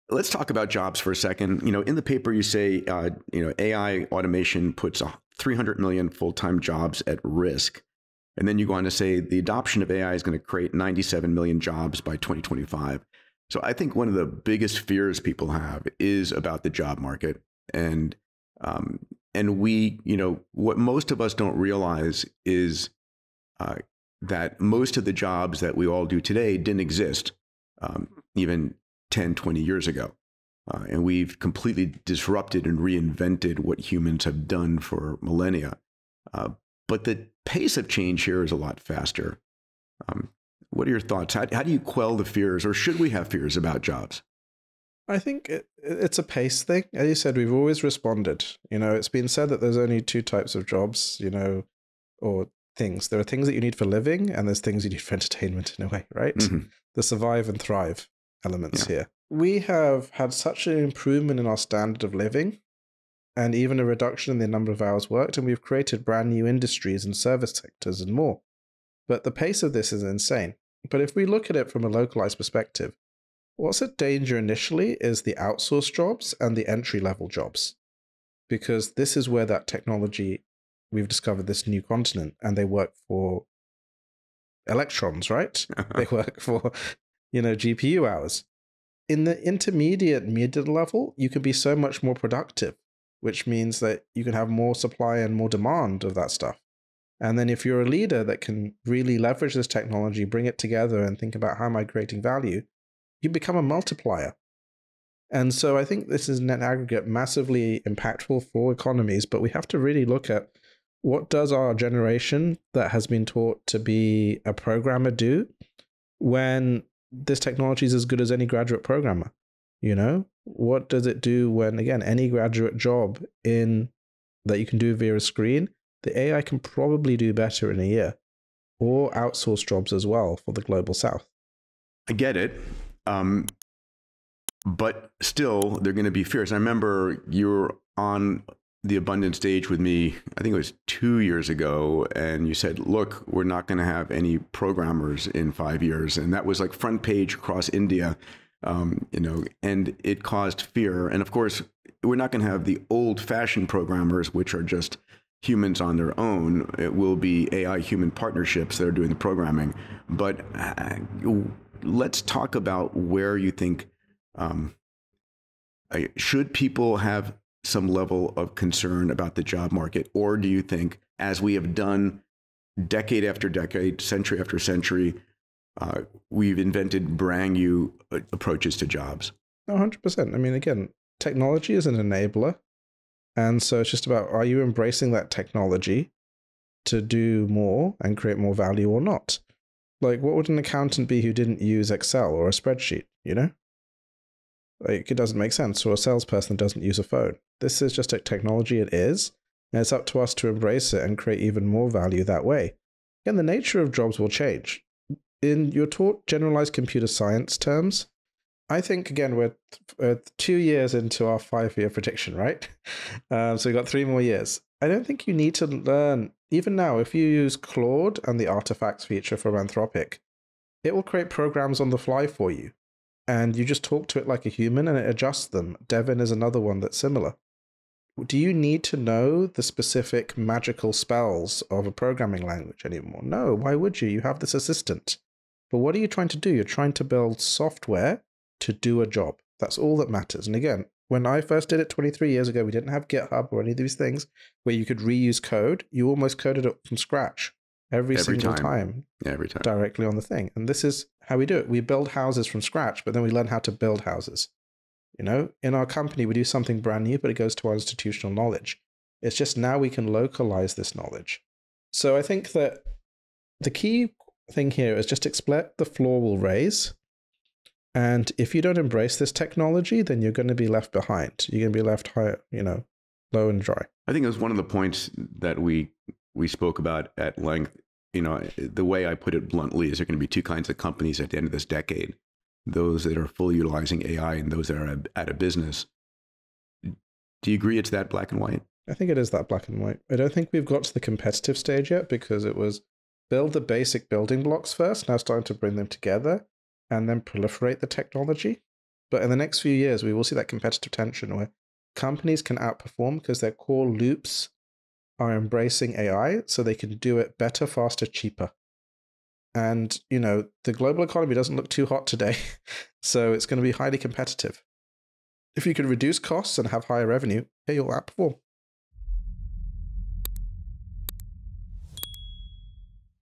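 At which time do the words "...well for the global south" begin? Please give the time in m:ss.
2:10.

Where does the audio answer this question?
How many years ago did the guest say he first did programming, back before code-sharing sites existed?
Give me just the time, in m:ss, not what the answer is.
4:01.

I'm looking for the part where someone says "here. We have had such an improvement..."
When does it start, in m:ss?
0:58.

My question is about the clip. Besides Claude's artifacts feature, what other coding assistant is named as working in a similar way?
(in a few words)
Devin.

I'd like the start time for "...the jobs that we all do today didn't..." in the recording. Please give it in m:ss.
0:25.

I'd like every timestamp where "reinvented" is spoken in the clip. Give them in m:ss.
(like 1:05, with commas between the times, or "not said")
0:32.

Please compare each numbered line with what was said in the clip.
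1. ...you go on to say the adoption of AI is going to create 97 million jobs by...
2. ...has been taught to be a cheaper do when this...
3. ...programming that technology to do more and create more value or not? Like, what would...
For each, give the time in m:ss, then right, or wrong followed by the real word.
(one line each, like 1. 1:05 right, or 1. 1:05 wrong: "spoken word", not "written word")
1. 0:08 right
2. 1:52 wrong: "programmer", not "cheaper"
3. 3:04 wrong: "embracing", not "programming".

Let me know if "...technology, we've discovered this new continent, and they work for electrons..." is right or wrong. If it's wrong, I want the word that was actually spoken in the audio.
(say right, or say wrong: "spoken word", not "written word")
right.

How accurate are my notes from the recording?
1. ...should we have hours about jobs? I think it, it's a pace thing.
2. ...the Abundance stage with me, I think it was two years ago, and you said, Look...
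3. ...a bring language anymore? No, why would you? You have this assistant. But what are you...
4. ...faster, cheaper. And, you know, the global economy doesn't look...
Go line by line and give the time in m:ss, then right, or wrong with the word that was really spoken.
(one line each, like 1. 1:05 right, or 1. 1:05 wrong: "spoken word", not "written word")
1. 0:42 wrong: "fears", not "hours"
2. 2:18 right
3. 3:51 wrong: "programming", not "bring"
4. 5:07 right.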